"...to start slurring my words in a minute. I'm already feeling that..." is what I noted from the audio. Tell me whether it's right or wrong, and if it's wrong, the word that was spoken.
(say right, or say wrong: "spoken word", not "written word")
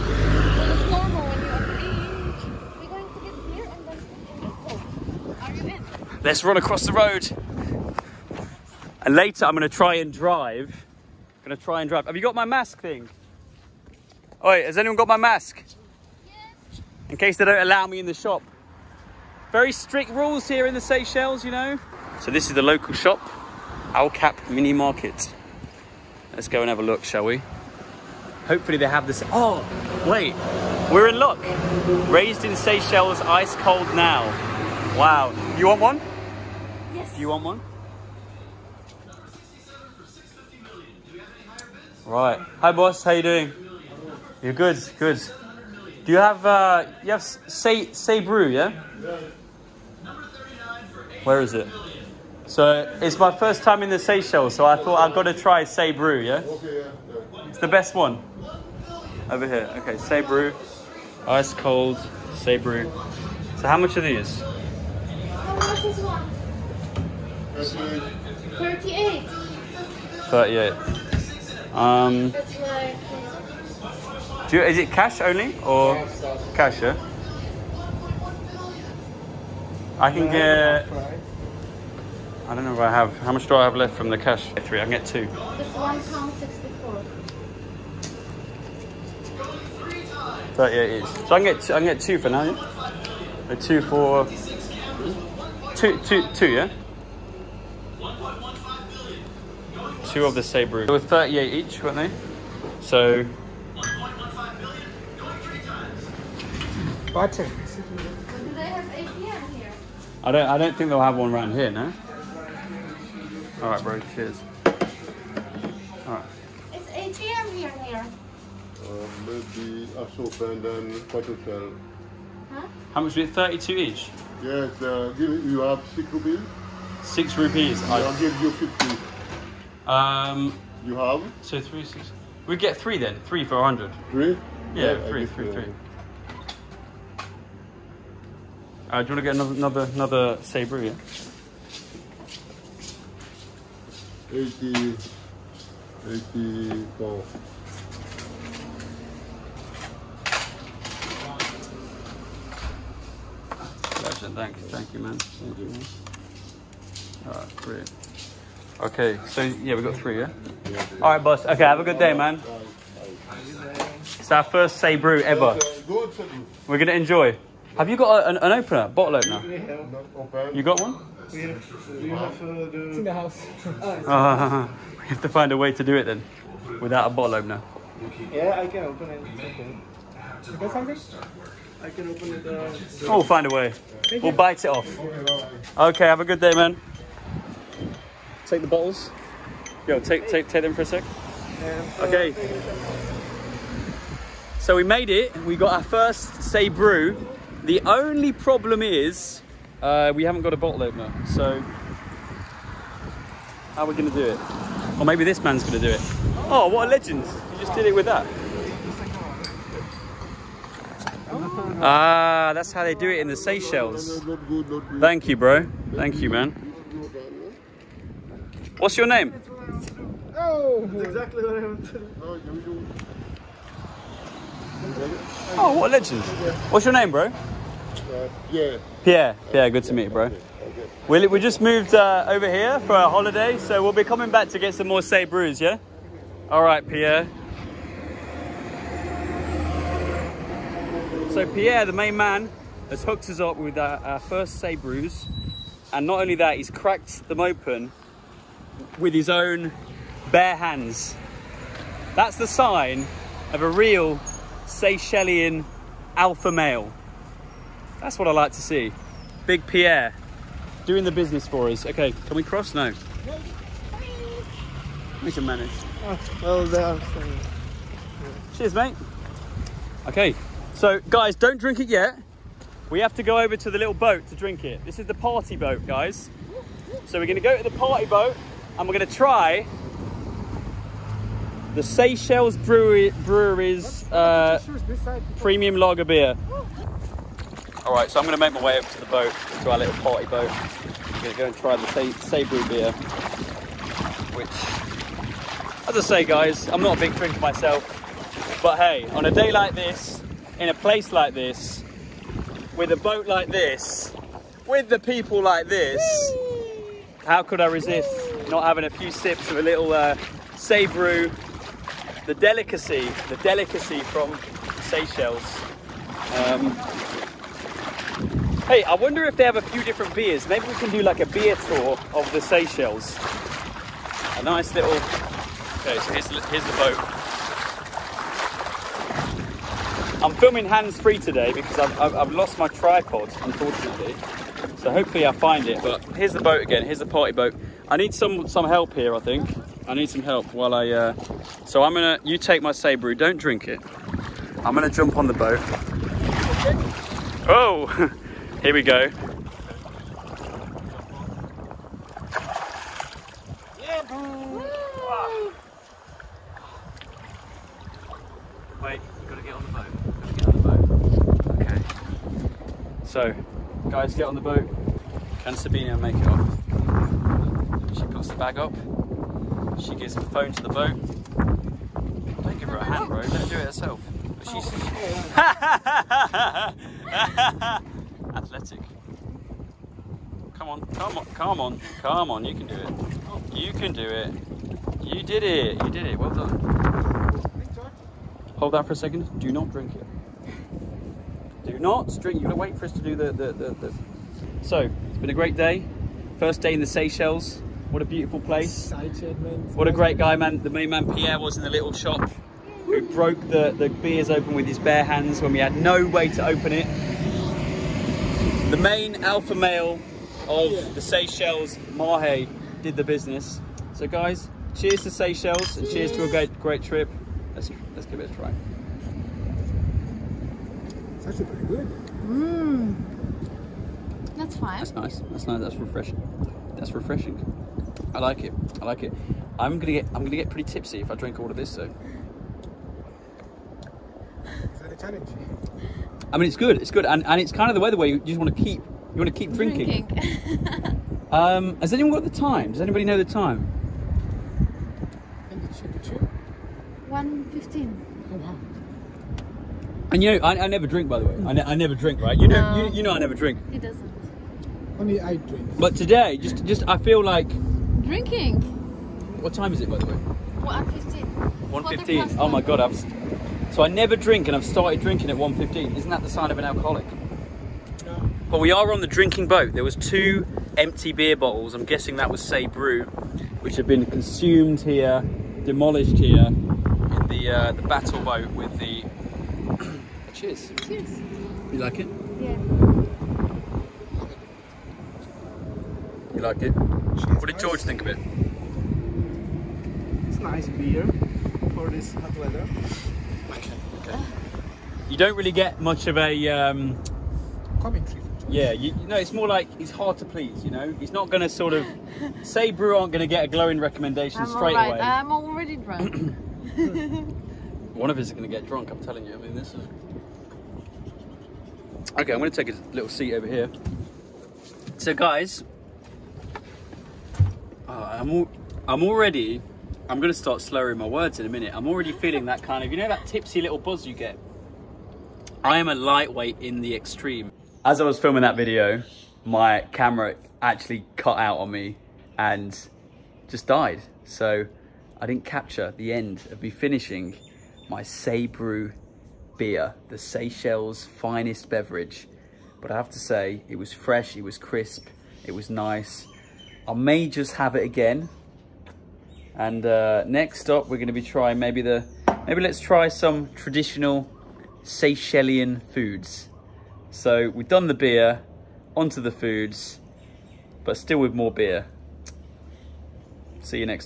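right.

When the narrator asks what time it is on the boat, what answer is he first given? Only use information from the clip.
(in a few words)
1:15.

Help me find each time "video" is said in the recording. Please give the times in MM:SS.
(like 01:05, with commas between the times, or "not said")
08:48.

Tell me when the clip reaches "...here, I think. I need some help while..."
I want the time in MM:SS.
05:38.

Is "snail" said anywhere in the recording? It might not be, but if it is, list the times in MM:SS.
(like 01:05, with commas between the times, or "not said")
not said.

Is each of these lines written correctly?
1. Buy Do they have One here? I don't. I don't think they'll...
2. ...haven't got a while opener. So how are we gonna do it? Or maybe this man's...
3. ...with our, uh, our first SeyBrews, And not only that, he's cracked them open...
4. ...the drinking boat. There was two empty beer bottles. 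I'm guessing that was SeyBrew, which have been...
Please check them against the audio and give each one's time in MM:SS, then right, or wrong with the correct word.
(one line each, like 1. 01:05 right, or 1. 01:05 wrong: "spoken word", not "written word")
1. 01:47 wrong: "APM", not "One"
2. 03:20 wrong: "bottle", not "while"
3. 04:03 right
4. 07:49 right.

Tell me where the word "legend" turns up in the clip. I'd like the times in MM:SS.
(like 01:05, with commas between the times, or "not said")
03:26, 03:45.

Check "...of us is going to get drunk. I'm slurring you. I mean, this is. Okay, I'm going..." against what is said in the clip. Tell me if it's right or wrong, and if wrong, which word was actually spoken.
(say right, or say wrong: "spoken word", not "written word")
wrong: "telling", not "slurring".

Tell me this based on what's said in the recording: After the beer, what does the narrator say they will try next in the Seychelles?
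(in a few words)
traditional Seychellian foods.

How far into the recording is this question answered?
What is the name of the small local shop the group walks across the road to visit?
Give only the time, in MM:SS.
00:23.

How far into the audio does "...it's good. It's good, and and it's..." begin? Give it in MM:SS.
07:16.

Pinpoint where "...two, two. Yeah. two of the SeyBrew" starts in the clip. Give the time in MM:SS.
01:36.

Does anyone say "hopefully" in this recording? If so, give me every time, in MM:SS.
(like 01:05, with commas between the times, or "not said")
00:28, 05:34.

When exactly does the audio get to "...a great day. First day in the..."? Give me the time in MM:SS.
06:35.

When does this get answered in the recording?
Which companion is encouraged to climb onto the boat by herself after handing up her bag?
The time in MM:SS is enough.
06:05.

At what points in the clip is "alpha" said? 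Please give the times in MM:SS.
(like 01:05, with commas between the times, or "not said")
04:16, 06:49.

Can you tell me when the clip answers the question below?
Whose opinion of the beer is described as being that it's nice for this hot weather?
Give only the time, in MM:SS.
08:07.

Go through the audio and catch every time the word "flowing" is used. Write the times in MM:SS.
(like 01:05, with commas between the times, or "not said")
not said.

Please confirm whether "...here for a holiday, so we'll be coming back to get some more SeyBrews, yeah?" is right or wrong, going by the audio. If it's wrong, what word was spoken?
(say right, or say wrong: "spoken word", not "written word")
right.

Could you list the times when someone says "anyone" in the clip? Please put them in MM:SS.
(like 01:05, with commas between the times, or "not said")
00:14, 07:21.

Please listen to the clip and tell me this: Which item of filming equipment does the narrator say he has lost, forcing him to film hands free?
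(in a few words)
tripod.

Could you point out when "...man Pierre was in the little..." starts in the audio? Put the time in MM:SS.
06:40.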